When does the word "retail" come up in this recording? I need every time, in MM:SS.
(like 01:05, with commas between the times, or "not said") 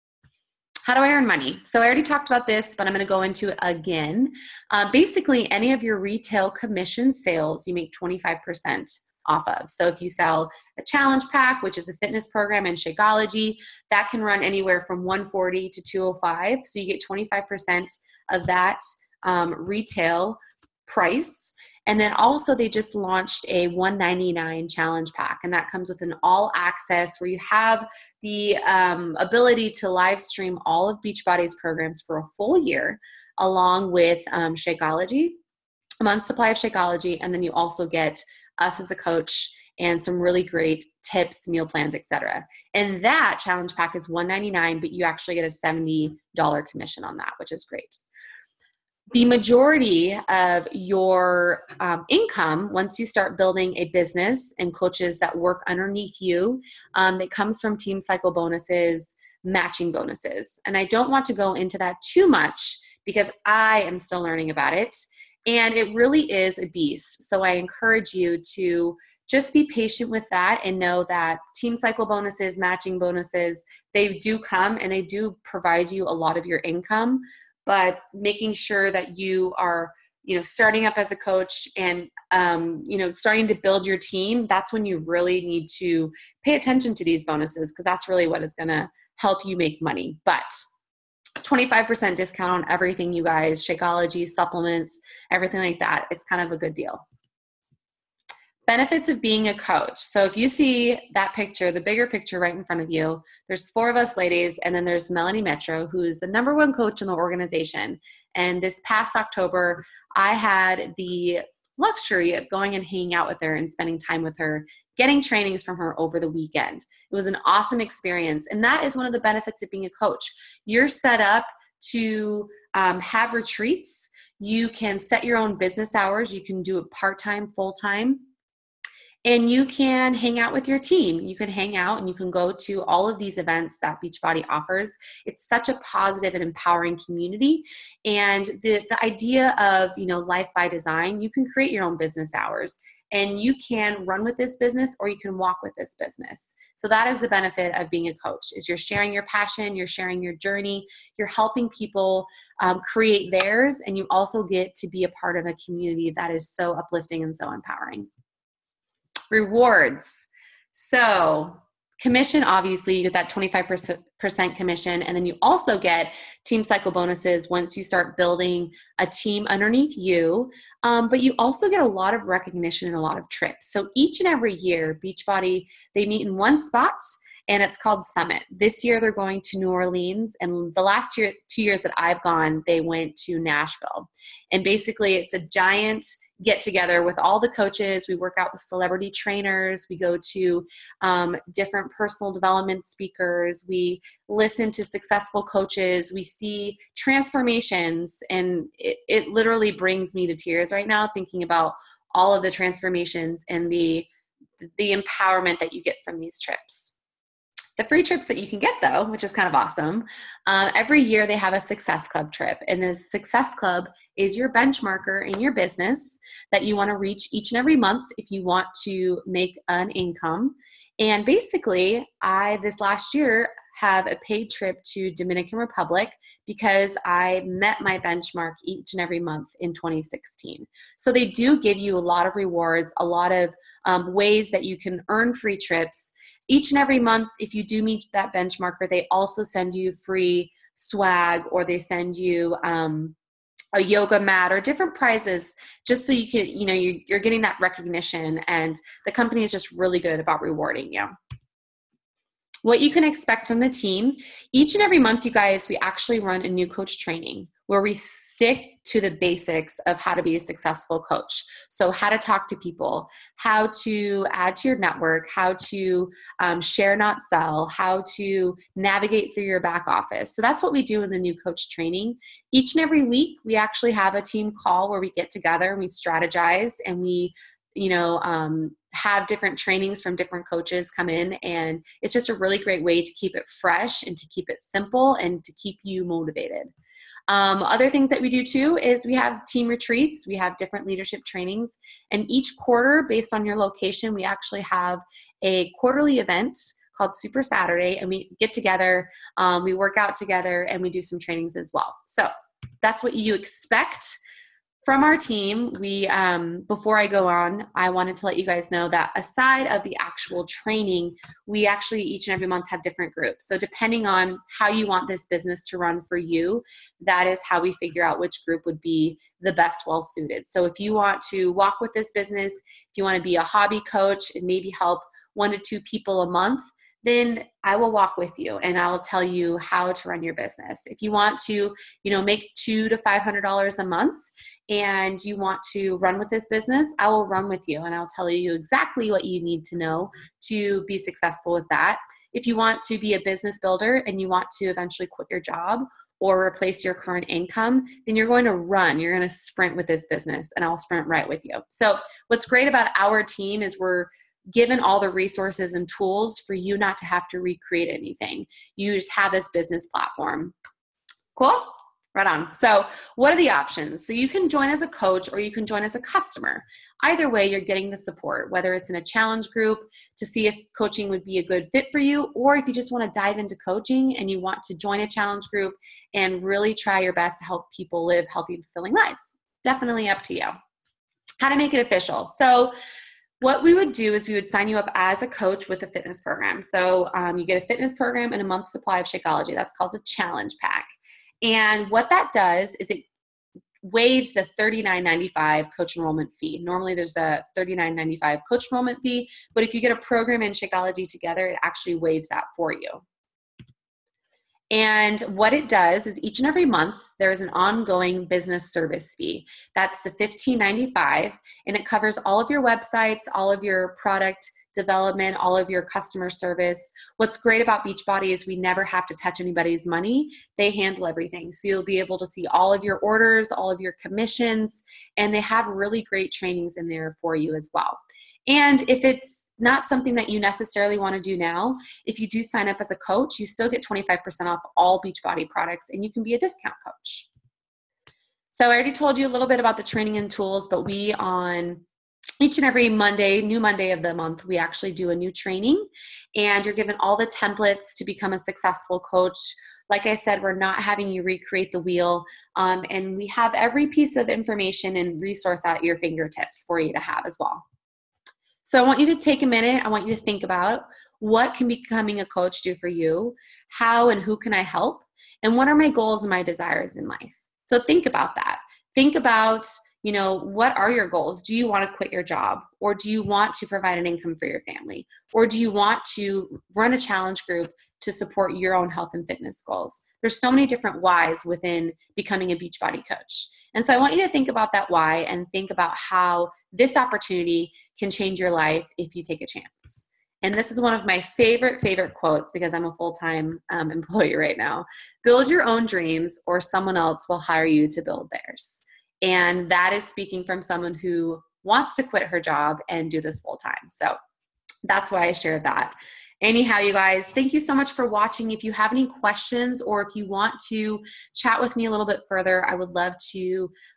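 00:05, 00:19.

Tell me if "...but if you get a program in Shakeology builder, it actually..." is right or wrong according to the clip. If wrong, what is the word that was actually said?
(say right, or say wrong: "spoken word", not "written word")
wrong: "together", not "builder".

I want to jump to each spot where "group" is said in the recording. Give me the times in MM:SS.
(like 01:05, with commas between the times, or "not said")
05:13, 05:18, 06:09, 06:15, 07:57.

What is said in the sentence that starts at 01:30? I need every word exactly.
But 25% discount on everything, you guys Shakeology, supplements, everything like that.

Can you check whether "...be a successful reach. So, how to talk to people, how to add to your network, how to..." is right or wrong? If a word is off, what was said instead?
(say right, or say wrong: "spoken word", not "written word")
wrong: "coach", not "reach".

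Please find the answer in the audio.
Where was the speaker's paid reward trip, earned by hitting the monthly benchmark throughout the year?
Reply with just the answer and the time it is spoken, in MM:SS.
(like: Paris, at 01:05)
Dominican Republic, at 03:45.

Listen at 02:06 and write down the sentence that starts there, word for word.
You can do it part time, full time.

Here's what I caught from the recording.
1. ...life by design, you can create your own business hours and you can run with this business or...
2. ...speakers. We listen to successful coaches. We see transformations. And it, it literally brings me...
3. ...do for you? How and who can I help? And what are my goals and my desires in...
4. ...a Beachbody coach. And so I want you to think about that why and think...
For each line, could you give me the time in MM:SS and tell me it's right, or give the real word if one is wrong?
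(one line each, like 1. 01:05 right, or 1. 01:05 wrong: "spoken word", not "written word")
1. 02:20 right
2. 03:12 right
3. 07:42 right
4. 08:02 right.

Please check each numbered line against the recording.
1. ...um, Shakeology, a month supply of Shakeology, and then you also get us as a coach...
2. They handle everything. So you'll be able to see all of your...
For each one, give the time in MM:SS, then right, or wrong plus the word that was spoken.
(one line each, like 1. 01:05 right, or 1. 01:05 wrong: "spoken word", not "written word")
1. 00:34 right
2. 07:00 right.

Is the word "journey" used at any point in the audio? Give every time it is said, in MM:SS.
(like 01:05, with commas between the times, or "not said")
02:30.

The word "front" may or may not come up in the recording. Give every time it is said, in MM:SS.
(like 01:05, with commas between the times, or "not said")
01:42.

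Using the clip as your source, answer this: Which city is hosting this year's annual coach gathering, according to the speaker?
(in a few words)
New Orleans.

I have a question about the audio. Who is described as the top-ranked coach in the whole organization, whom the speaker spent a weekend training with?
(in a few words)
Melanie Mitro.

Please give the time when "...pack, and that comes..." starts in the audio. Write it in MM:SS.
00:25.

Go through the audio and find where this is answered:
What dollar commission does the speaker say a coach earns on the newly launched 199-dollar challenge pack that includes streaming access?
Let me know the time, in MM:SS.
00:45.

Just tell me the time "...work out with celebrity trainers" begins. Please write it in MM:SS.
03:08.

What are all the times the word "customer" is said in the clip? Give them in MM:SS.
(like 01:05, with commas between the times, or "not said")
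06:05, 06:55.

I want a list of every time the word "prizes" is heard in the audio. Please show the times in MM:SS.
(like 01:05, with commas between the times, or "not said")
04:04.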